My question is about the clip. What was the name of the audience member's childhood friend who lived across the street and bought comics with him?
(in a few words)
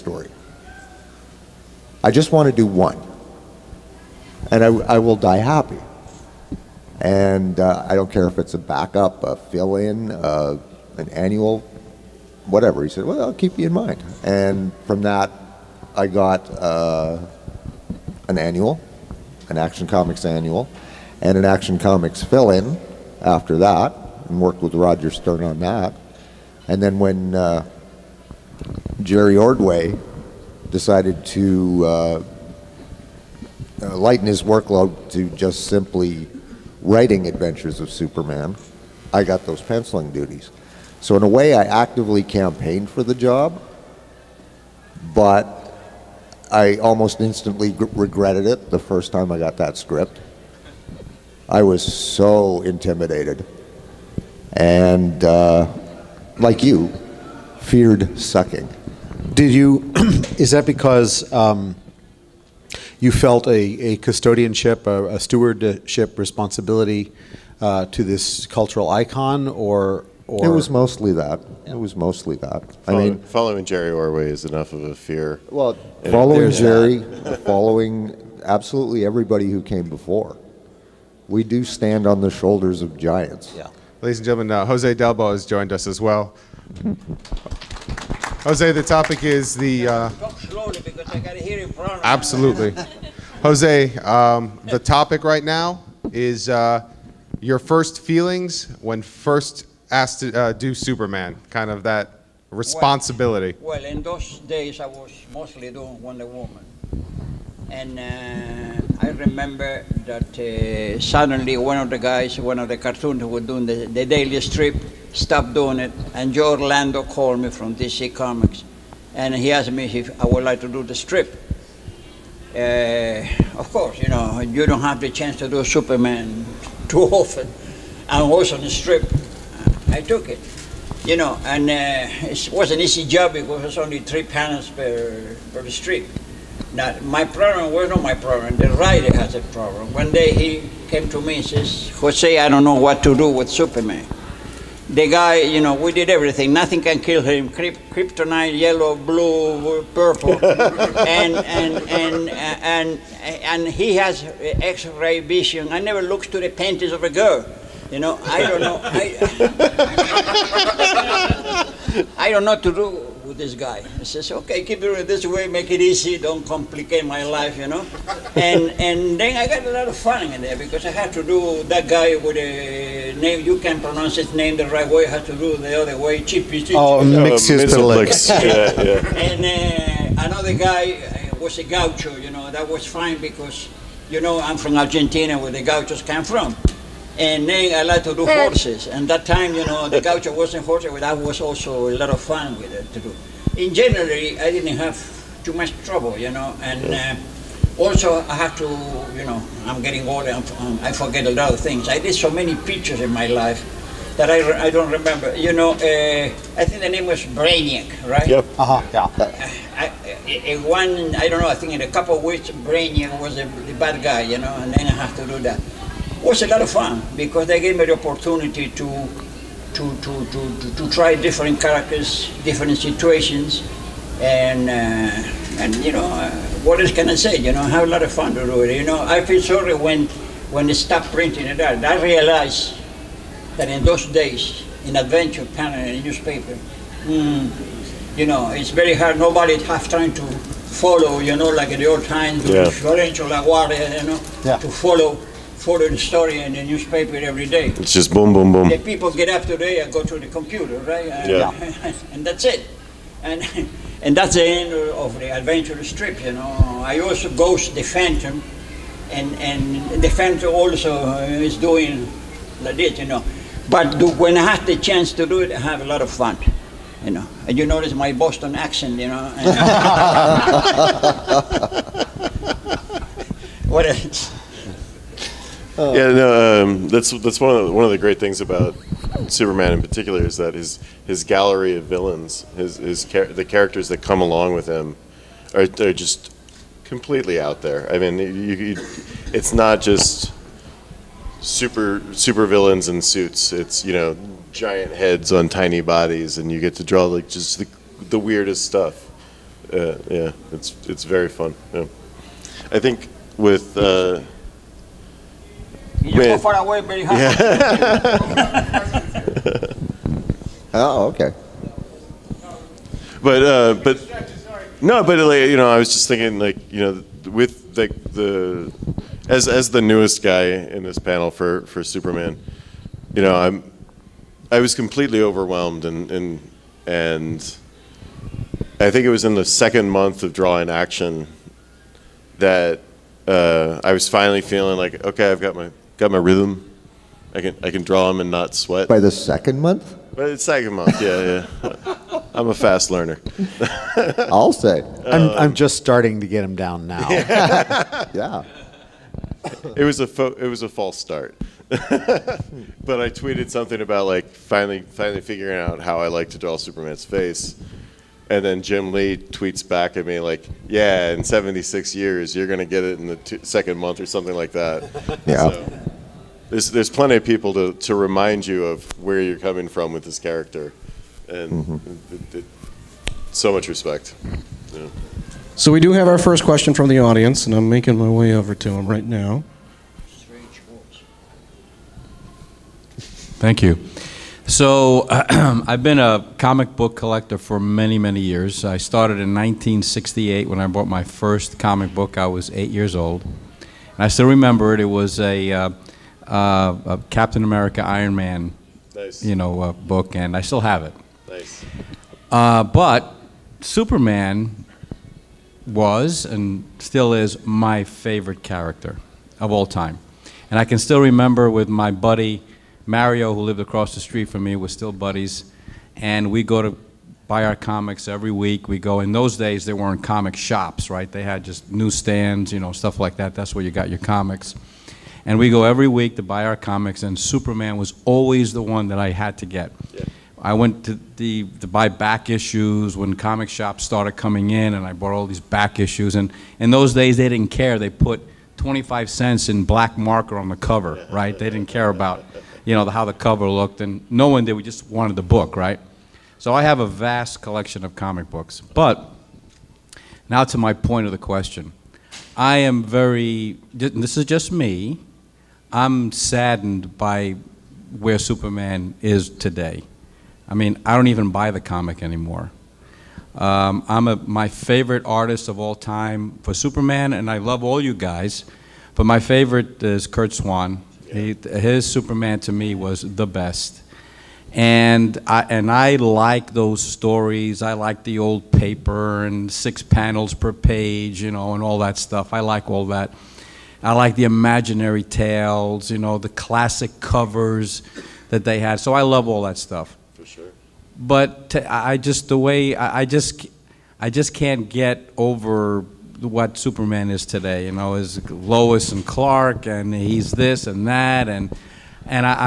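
Mario.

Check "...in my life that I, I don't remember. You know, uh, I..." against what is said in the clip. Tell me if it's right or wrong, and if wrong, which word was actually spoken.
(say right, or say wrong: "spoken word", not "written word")
right.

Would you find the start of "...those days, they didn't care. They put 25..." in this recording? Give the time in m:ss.
7:16.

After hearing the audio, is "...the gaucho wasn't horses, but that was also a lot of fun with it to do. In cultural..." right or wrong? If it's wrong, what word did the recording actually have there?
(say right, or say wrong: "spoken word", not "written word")
wrong: "general", not "cultural".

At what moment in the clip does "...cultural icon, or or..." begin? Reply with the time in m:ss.
1:08.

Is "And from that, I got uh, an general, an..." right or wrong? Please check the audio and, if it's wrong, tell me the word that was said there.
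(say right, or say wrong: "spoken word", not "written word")
wrong: "annual", not "general".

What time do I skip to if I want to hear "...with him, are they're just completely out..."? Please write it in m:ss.
4:44.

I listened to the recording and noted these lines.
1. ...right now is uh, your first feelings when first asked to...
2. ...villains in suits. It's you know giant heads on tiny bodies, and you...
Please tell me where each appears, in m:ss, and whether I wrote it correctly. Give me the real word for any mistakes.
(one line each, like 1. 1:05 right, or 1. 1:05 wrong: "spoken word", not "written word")
1. 1:35 right
2. 4:52 right.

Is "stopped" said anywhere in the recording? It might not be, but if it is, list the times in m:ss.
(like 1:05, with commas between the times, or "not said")
1:55, 3:50.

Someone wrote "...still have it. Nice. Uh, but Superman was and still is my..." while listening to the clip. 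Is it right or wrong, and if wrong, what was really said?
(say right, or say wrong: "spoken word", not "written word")
right.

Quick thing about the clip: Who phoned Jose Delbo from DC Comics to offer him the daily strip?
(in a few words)
Joe Orlando.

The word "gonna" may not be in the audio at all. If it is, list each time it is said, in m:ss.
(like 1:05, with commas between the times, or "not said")
6:02.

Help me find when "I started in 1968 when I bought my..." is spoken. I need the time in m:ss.
6:28.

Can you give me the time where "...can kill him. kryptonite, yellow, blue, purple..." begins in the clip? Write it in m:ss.
2:26.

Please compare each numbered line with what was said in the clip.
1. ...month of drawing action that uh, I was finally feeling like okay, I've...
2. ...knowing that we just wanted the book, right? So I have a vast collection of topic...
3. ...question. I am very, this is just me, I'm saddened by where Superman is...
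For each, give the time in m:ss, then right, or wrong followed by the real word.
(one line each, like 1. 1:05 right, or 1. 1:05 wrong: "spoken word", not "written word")
1. 5:29 right
2. 7:24 wrong: "comic", not "topic"
3. 7:31 right.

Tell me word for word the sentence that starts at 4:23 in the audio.
But do, when I have the chance to do it, I have a lot of fun you know.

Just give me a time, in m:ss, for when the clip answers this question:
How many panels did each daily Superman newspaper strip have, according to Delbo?
2:13.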